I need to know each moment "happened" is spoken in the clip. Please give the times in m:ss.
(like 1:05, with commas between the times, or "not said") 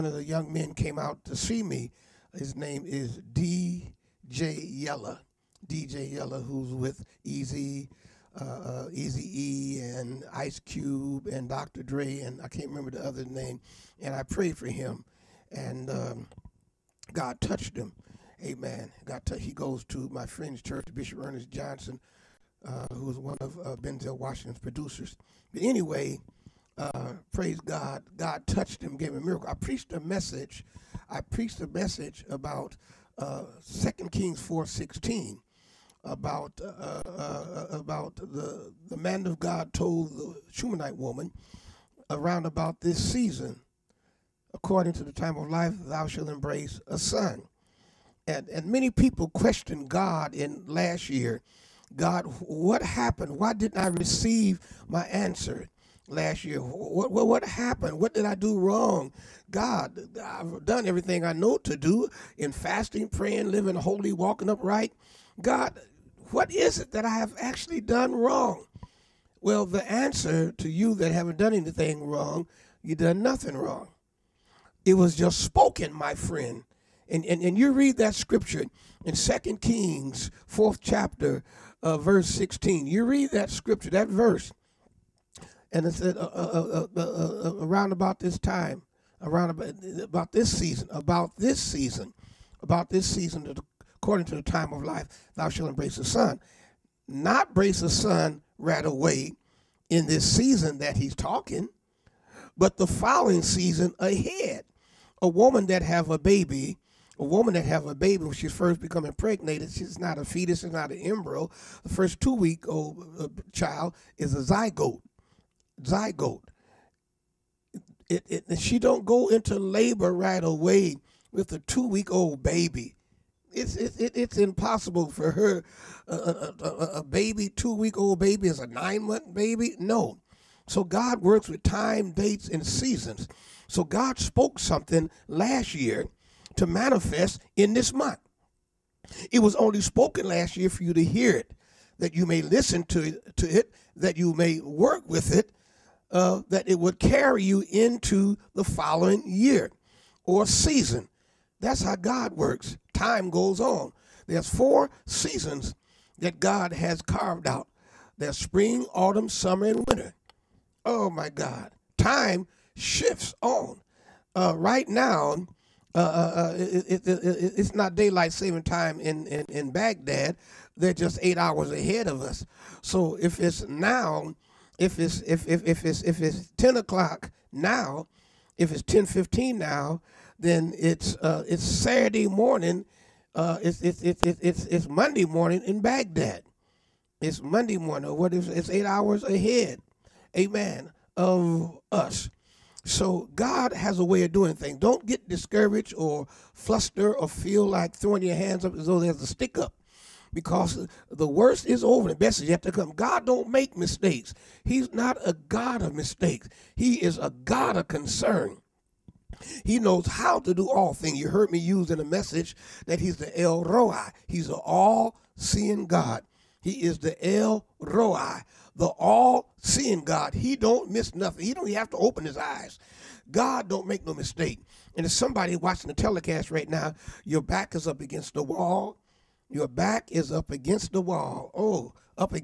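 0:52, 0:57.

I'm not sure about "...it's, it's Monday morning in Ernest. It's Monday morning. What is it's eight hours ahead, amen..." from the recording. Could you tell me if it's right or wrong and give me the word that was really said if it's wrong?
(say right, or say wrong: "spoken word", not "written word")
wrong: "Baghdad", not "Ernest".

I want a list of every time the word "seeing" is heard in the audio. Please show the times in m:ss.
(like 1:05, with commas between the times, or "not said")
3:34, 3:38.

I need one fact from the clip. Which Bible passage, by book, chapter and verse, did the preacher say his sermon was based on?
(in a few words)
2 Kings 4:16.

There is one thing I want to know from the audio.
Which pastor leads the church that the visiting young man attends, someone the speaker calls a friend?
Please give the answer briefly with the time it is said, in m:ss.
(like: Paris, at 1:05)
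Bishop Ernest Johnson, at 0:20.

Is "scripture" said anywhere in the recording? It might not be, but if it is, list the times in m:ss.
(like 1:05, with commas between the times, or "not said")
1:18, 1:23.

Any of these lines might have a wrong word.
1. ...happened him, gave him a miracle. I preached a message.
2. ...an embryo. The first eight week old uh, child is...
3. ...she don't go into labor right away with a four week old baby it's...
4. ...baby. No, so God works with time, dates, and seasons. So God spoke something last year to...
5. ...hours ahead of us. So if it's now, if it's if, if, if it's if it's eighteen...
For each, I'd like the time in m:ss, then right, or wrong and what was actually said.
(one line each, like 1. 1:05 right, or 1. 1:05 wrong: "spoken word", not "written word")
1. 0:28 wrong: "touched", not "happened"
2. 1:50 wrong: "two", not "eight"
3. 1:58 wrong: "two", not "four"
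4. 2:09 right
5. 2:51 wrong: "ten", not "eighteen".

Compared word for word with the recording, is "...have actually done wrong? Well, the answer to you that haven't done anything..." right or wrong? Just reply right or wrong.
right.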